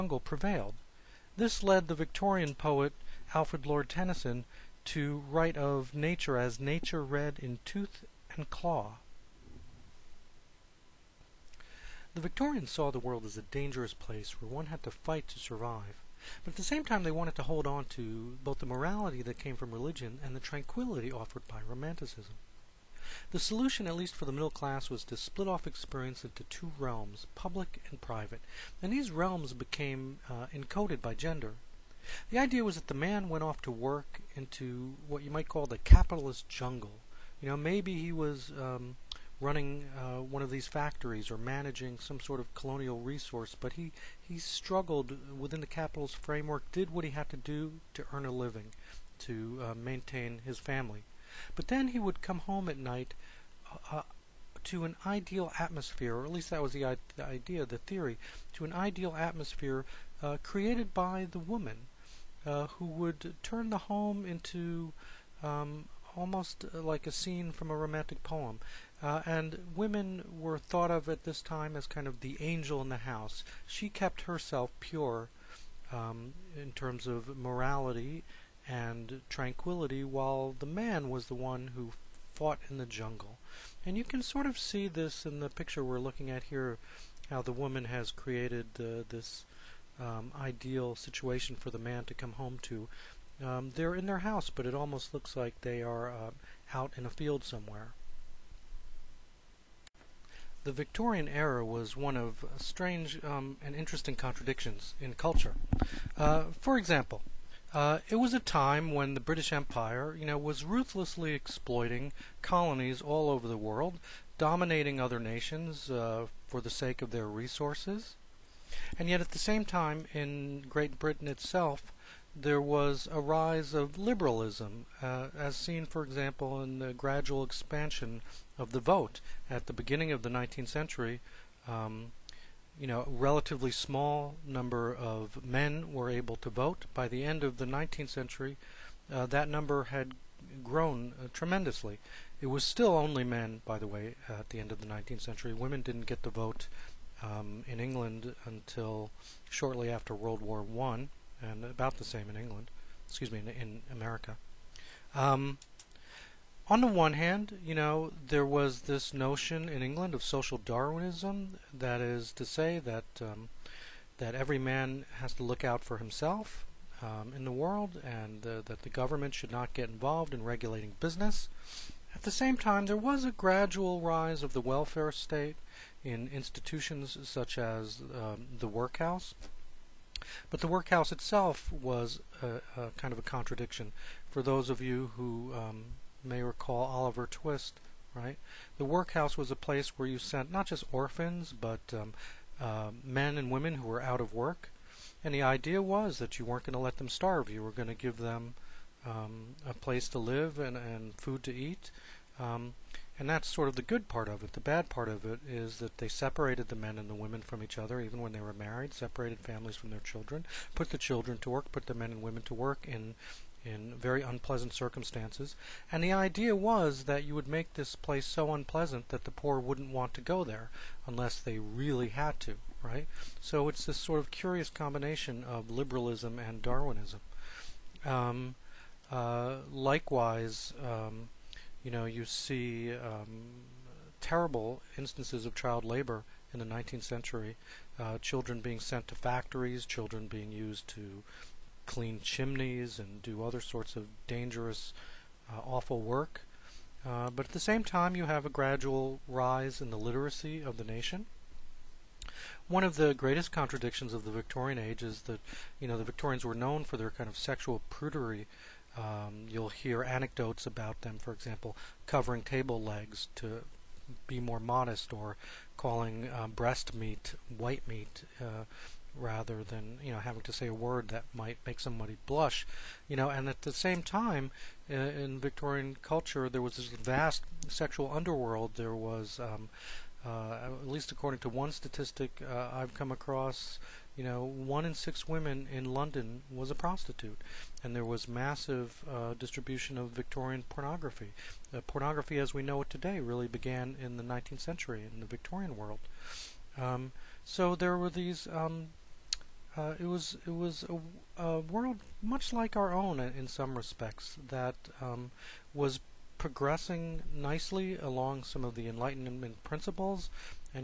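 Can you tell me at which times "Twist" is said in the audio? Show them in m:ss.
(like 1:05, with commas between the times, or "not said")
3:07.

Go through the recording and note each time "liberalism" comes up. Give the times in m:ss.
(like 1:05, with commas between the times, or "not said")
2:03, 3:45.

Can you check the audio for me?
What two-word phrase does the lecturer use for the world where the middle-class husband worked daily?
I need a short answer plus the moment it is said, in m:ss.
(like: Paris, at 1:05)
capitalist jungle, at 0:35.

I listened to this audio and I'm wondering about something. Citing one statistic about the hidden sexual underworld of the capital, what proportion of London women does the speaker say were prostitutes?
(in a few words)
1 in 6.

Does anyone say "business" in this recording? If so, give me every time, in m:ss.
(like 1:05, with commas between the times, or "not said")
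2:51.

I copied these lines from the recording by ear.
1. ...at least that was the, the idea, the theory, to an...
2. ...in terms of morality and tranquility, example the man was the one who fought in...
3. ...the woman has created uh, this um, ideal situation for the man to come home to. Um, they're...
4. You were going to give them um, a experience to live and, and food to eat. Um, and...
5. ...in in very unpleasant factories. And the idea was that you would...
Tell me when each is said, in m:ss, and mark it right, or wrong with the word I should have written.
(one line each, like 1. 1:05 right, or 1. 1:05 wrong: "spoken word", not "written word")
1. 0:56 right
2. 1:16 wrong: "while", not "example"
3. 1:27 right
4. 3:17 wrong: "place", not "experience"
5. 3:32 wrong: "circumstances", not "factories".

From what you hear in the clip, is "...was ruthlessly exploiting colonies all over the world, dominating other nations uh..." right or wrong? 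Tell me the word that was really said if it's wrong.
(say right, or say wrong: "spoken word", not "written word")
right.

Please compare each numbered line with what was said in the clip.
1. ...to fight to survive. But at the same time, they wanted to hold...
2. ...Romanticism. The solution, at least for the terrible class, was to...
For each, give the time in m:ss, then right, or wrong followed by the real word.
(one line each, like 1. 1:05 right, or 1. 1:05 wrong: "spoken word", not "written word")
1. 0:14 right
2. 0:21 wrong: "middle", not "terrible".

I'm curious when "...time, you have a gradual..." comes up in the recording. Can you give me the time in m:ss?
4:07.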